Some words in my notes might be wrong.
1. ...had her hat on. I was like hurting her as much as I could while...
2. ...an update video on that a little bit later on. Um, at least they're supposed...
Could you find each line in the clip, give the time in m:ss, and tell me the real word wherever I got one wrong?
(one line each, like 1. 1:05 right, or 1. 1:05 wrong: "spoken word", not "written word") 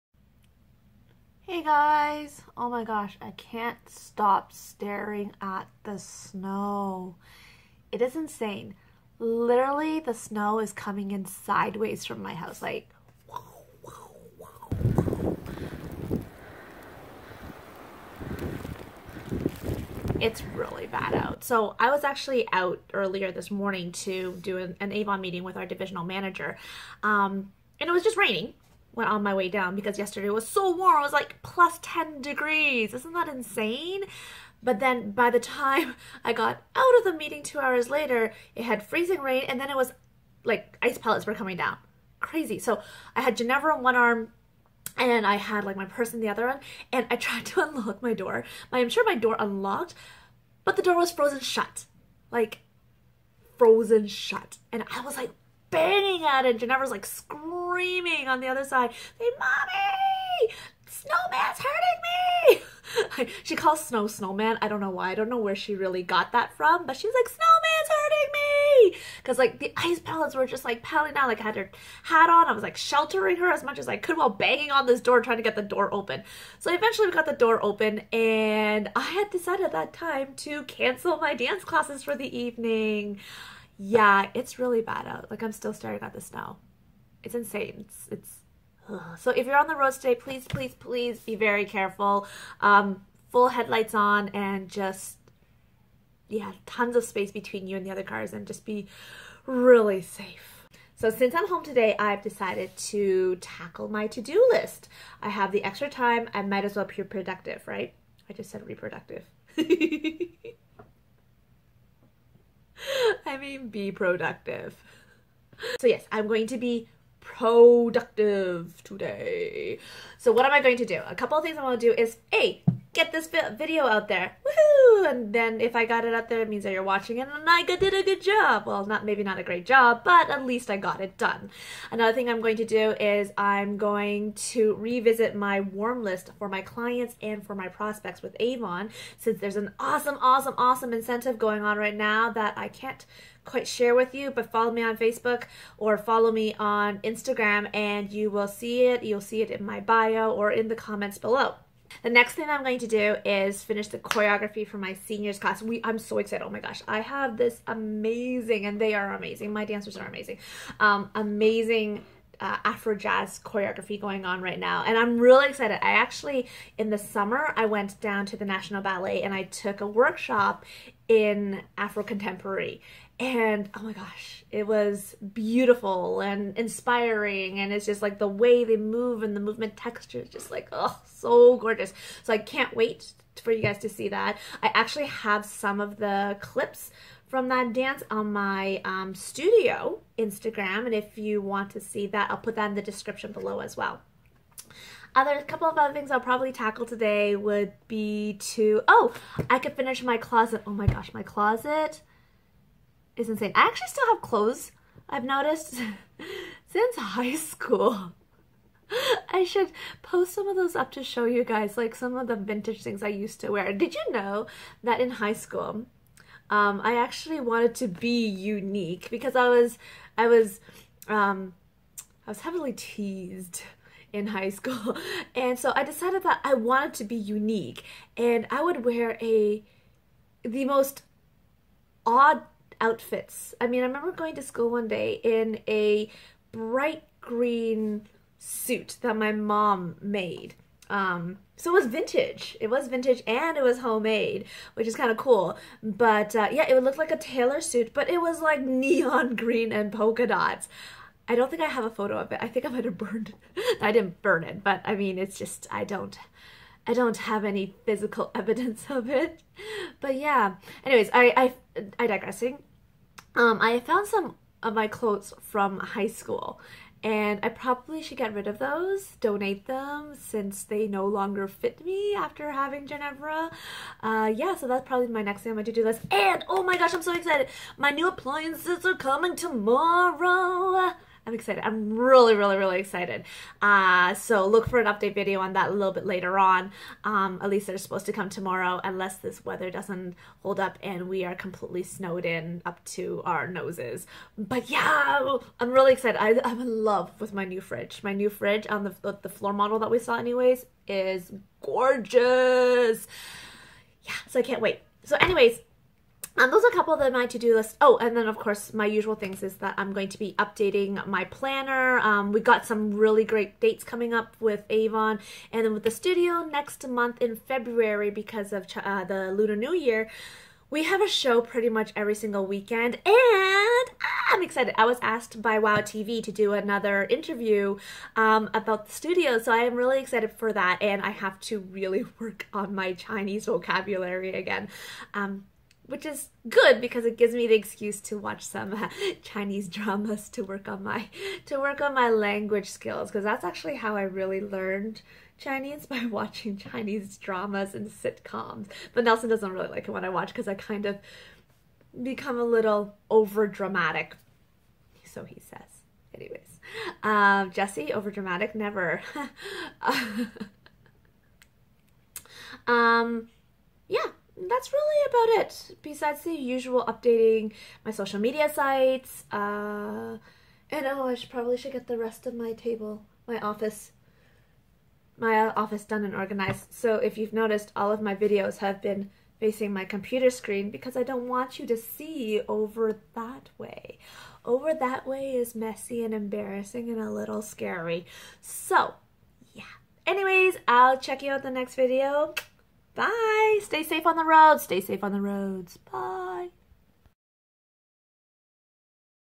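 1. 1:11 wrong: "sheltering", not "hurting"
2. 4:44 right.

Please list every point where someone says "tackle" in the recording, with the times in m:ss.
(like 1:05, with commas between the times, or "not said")
1:43, 3:16.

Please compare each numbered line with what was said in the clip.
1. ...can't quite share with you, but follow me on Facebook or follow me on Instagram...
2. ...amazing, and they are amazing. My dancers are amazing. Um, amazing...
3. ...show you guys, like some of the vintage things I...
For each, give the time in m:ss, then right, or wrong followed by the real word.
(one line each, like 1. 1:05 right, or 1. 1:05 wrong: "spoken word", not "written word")
1. 2:22 right
2. 2:37 right
3. 3:31 right.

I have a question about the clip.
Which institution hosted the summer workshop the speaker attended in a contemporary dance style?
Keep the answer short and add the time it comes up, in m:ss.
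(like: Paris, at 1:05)
National Ballet, at 2:48.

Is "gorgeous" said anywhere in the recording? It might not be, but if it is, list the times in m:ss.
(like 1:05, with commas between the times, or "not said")
3:01, 5:01.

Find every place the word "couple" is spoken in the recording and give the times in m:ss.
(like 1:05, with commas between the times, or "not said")
2:01, 3:15, 5:06.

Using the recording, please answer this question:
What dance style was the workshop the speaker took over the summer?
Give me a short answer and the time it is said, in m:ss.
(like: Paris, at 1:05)
Afro Contemporary, at 2:51.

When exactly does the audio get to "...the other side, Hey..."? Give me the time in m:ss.
0:58.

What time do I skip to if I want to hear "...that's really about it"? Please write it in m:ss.
6:04.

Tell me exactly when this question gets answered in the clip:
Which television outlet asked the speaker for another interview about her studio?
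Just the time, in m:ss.
5:25.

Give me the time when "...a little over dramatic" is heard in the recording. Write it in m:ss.
5:52.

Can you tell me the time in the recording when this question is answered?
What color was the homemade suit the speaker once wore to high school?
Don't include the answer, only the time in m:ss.
3:56.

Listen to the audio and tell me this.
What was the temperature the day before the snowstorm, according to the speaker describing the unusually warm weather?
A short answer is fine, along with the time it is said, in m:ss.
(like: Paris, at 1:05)
plus 10 degrees, at 0:31.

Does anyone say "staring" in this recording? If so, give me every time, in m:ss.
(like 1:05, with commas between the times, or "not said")
0:04, 1:25.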